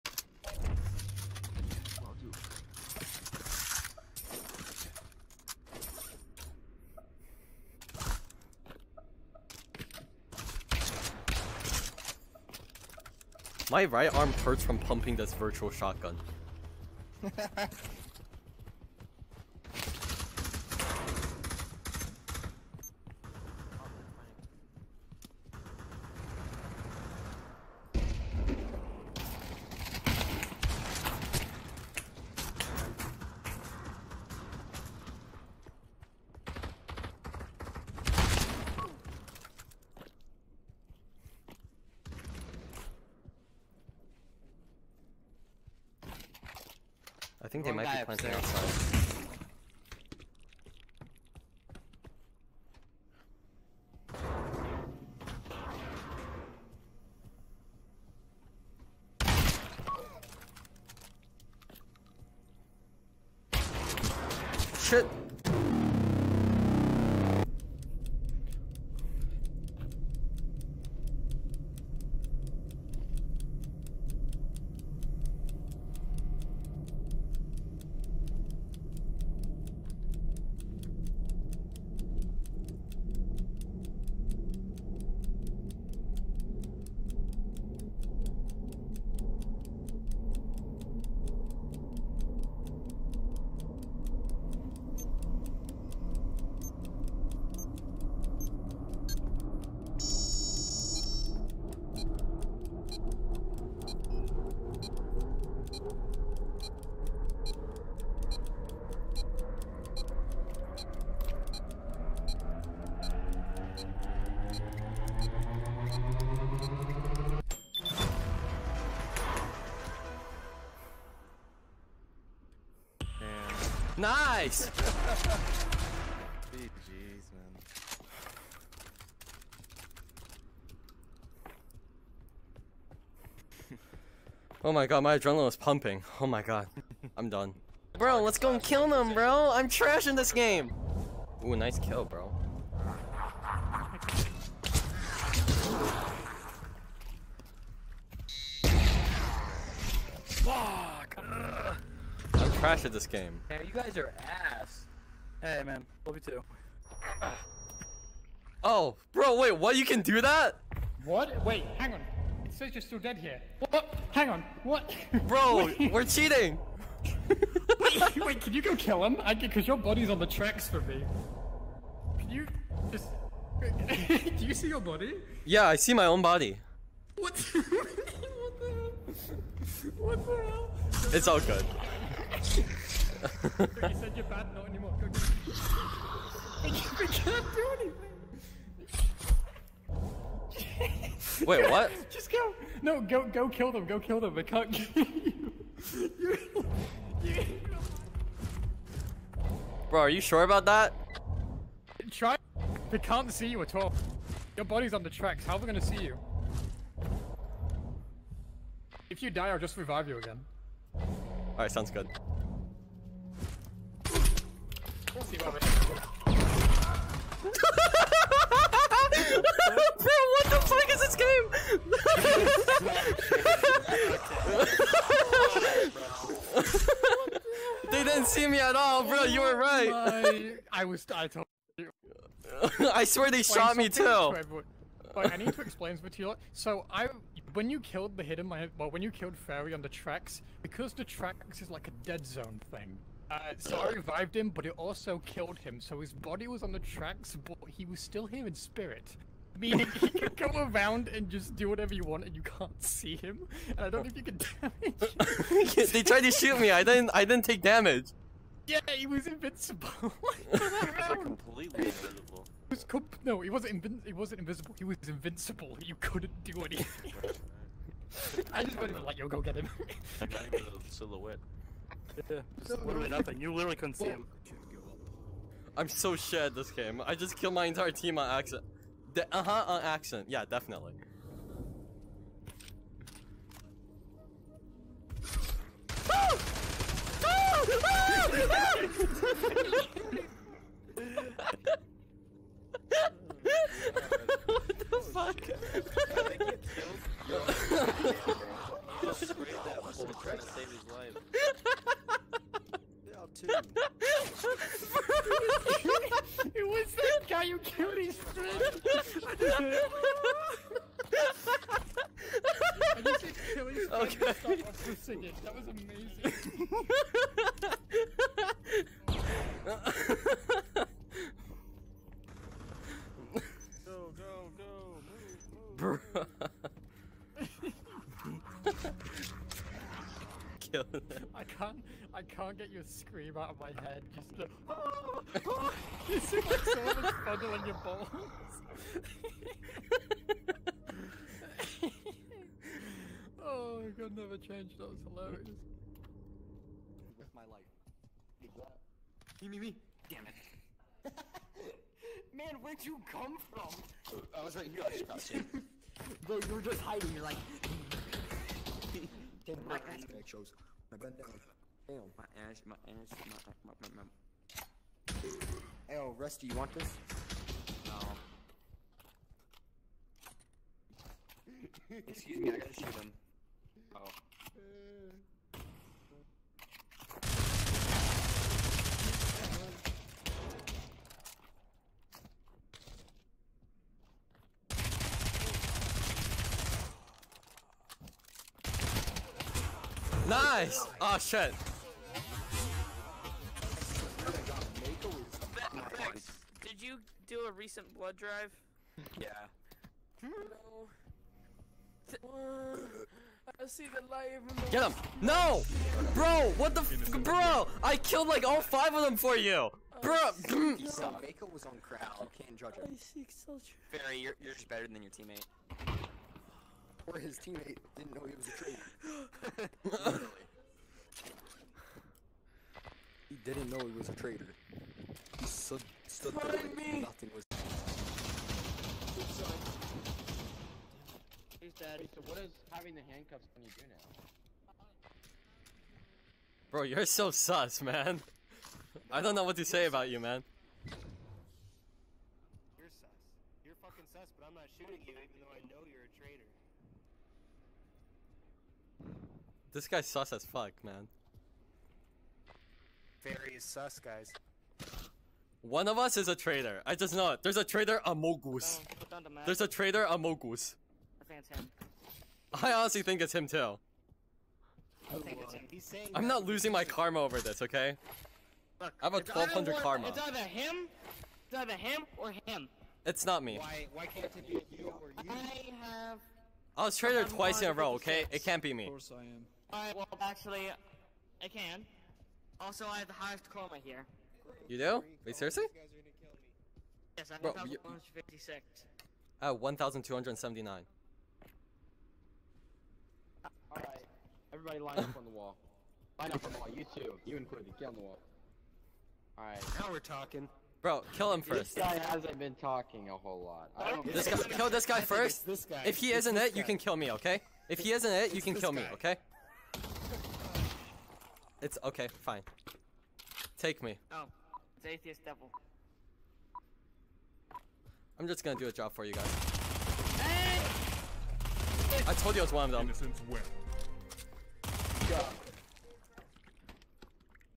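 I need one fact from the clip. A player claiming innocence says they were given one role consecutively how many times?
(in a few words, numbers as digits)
Twice.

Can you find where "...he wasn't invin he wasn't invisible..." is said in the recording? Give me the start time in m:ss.
4:23.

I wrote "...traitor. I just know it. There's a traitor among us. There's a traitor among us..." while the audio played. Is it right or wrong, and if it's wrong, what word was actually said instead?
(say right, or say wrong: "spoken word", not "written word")
right.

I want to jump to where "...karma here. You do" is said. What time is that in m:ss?
8:03.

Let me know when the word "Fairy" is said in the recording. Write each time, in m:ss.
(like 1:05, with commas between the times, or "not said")
3:59, 6:53.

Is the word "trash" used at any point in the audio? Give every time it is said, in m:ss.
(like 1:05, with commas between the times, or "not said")
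2:19, 2:32.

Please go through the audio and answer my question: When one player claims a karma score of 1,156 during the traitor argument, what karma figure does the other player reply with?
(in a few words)
1,279.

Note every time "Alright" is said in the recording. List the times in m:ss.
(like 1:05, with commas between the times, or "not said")
3:31, 7:59, 8:13, 8:19.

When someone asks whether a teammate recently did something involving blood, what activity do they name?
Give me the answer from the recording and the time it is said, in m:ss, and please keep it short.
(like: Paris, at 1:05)
Blood drive, at 6:37.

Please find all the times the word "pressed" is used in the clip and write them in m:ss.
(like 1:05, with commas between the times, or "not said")
not said.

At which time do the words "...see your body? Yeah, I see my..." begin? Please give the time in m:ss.
2:54.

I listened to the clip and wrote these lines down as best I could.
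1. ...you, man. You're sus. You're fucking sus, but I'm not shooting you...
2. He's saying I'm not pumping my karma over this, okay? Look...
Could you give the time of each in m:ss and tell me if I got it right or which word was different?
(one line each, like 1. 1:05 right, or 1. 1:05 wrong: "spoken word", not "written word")
1. 7:20 right
2. 7:45 wrong: "losing", not "pumping".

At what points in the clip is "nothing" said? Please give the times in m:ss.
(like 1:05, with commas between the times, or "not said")
4:33, 7:07.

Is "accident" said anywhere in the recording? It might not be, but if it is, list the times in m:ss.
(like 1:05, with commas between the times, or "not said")
4:38.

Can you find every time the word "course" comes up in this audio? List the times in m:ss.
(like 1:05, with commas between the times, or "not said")
7:58.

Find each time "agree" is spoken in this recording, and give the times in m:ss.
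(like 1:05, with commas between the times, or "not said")
not said.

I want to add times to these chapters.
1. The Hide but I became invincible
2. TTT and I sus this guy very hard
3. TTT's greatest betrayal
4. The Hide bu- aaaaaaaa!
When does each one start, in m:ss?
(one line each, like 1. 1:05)
1. 2:17
2. 7:07
3. 5:47
4. 4:35.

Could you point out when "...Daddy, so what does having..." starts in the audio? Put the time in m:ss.
7:11.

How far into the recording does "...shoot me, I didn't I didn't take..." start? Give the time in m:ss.
4:16.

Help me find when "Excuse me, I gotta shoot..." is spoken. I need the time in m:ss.
6:12.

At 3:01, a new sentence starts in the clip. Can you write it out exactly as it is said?
It's all good you said you're bad, not anymore.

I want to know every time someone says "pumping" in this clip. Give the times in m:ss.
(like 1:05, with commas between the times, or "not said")
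0:14, 2:15.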